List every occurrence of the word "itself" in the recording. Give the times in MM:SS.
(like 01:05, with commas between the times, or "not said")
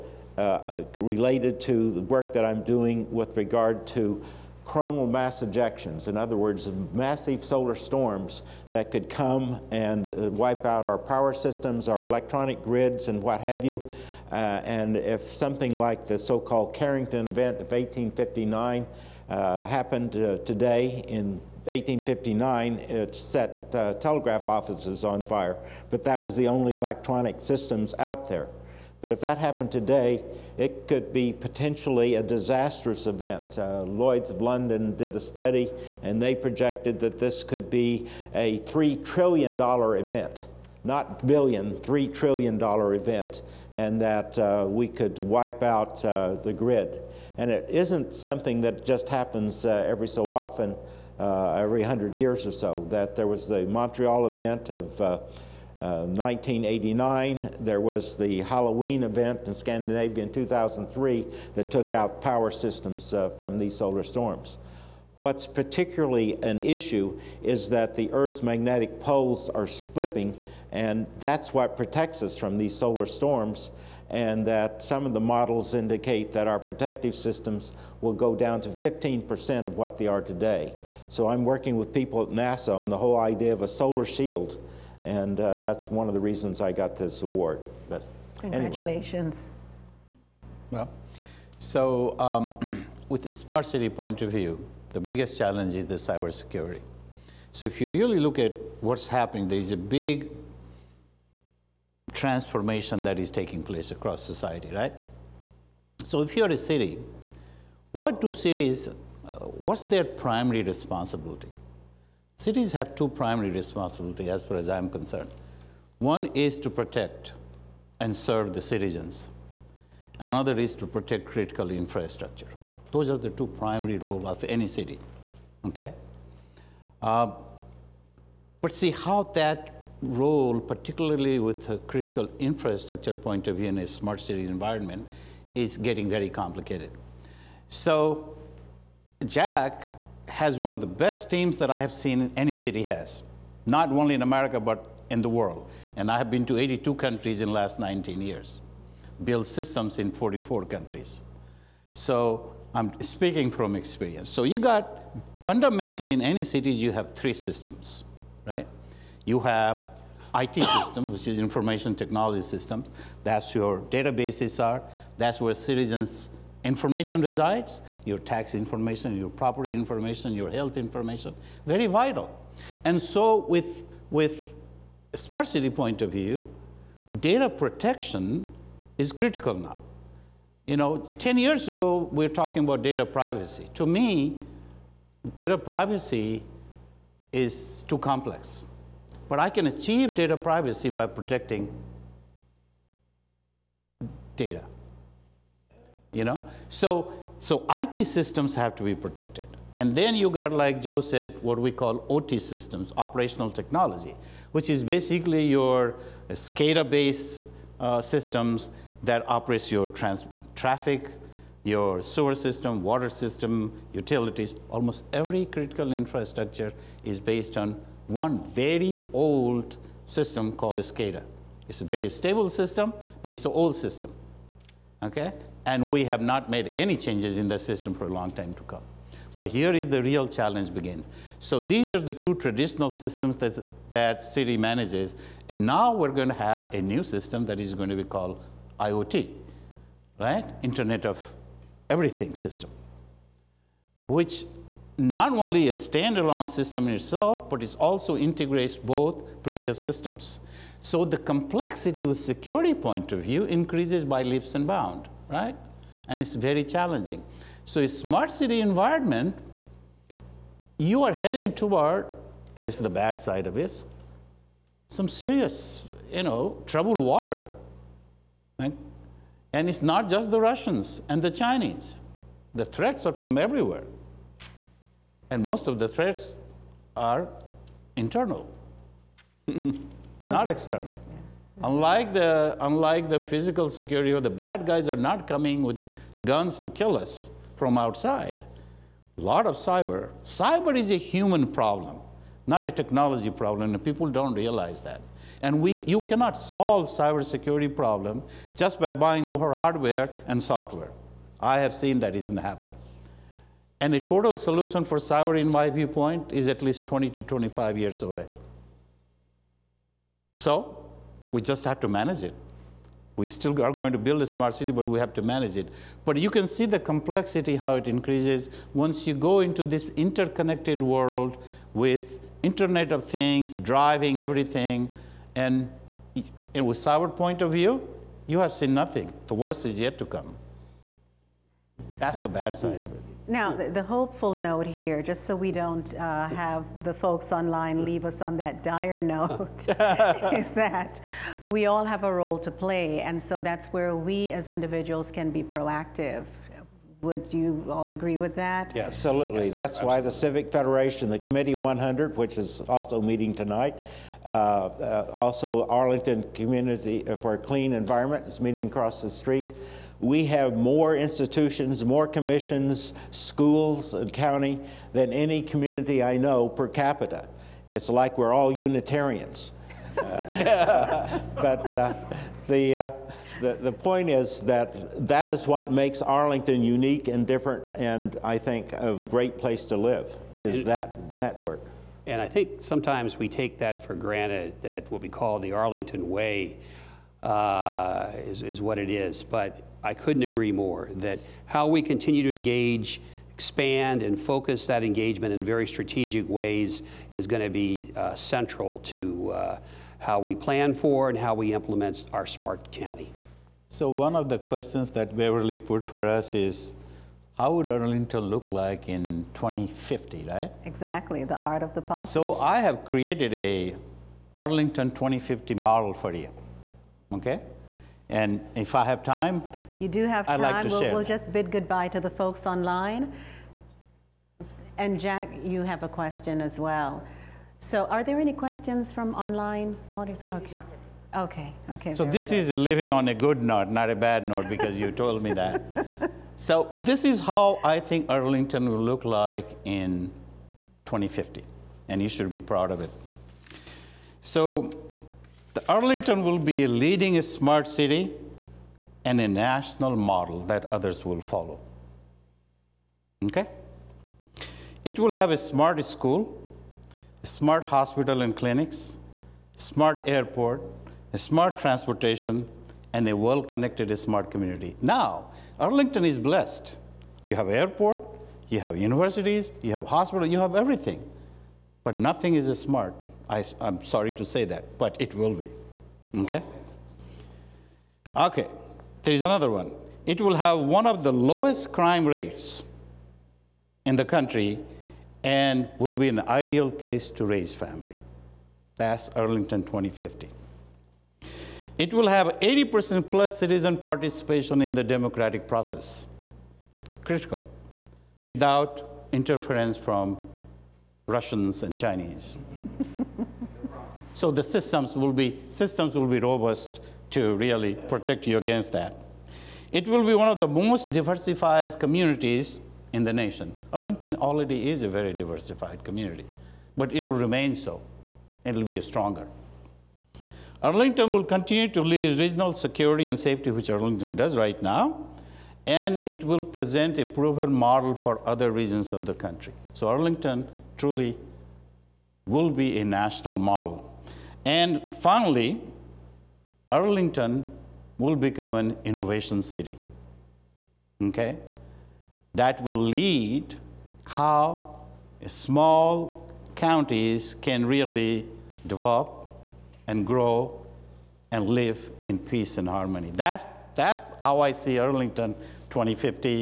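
04:06.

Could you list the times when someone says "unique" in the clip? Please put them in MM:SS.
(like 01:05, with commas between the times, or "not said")
06:16.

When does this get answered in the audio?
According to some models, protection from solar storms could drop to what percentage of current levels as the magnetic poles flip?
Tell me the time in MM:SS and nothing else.
01:18.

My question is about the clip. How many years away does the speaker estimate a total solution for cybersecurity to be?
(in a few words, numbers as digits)
20 to 25 years.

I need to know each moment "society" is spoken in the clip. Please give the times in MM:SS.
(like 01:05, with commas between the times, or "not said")
01:44.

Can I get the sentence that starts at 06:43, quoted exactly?
So one of the questions that Beverly put for us is, how would Arlington look like in 2050, right?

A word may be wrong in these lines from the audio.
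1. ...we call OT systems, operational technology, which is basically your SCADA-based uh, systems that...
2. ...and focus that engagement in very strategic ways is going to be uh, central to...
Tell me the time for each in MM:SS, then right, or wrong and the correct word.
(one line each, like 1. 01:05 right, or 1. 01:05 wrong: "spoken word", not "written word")
1. 03:21 right
2. 06:34 right.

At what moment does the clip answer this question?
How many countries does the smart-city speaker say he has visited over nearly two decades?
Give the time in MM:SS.
02:26.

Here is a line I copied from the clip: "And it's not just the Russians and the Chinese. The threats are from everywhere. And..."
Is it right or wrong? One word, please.
right.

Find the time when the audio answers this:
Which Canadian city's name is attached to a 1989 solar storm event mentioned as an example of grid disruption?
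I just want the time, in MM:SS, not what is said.
00:53.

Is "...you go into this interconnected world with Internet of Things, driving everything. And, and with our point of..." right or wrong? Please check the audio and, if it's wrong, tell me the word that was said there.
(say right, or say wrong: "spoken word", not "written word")
right.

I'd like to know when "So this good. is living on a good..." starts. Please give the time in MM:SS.
07:11.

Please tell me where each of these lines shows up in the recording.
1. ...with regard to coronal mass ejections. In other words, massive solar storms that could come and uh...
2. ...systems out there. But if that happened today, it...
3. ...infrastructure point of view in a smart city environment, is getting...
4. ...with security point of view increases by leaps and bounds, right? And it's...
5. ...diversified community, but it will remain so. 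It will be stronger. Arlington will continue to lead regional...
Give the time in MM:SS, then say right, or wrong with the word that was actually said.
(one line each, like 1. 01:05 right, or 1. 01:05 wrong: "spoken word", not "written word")
1. 00:03 right
2. 00:27 right
3. 02:12 right
4. 04:12 right
5. 08:35 right.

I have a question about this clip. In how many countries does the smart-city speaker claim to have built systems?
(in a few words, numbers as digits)
44.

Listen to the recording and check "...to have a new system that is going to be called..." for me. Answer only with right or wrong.
right.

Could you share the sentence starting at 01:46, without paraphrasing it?
So if you're a city, what do cities, uh, what's their primary responsibility?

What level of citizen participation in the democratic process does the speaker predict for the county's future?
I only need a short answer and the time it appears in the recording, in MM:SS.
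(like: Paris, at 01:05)
80% plus, at 08:12.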